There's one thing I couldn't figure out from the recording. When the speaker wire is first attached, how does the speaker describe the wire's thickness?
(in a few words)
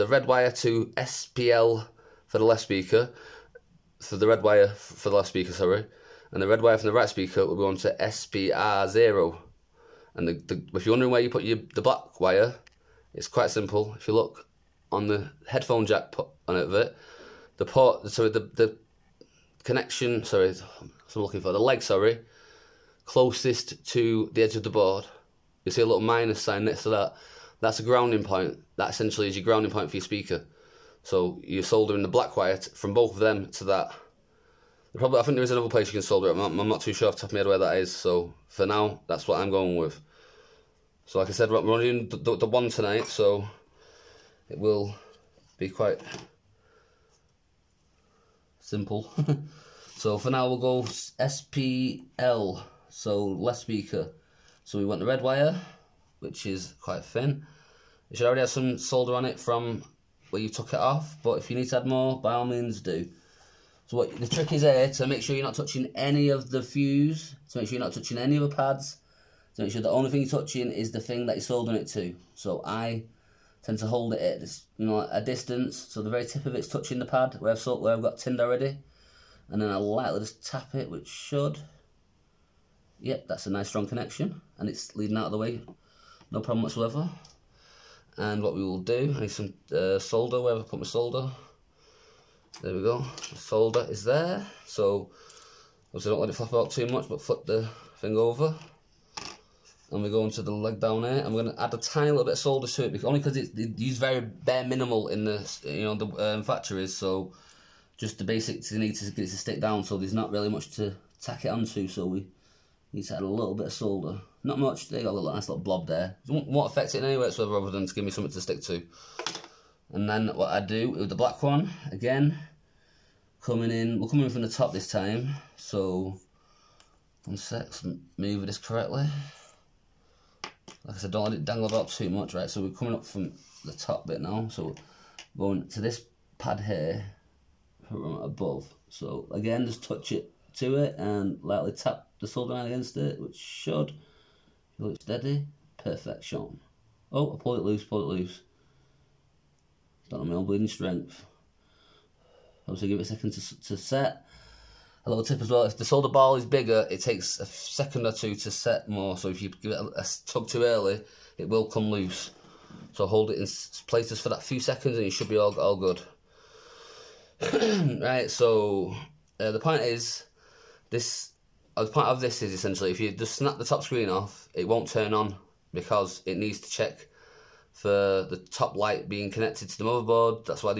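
quite thin.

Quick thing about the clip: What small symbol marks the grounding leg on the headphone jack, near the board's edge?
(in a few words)
minus sign.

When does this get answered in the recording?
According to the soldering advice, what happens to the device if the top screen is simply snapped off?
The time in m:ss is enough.
2:54.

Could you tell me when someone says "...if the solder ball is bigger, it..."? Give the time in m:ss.
2:35.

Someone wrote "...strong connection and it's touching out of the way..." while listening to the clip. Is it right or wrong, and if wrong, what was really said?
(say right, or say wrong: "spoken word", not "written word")
wrong: "leading", not "touching".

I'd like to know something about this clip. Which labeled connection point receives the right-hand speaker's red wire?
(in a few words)
SPR0.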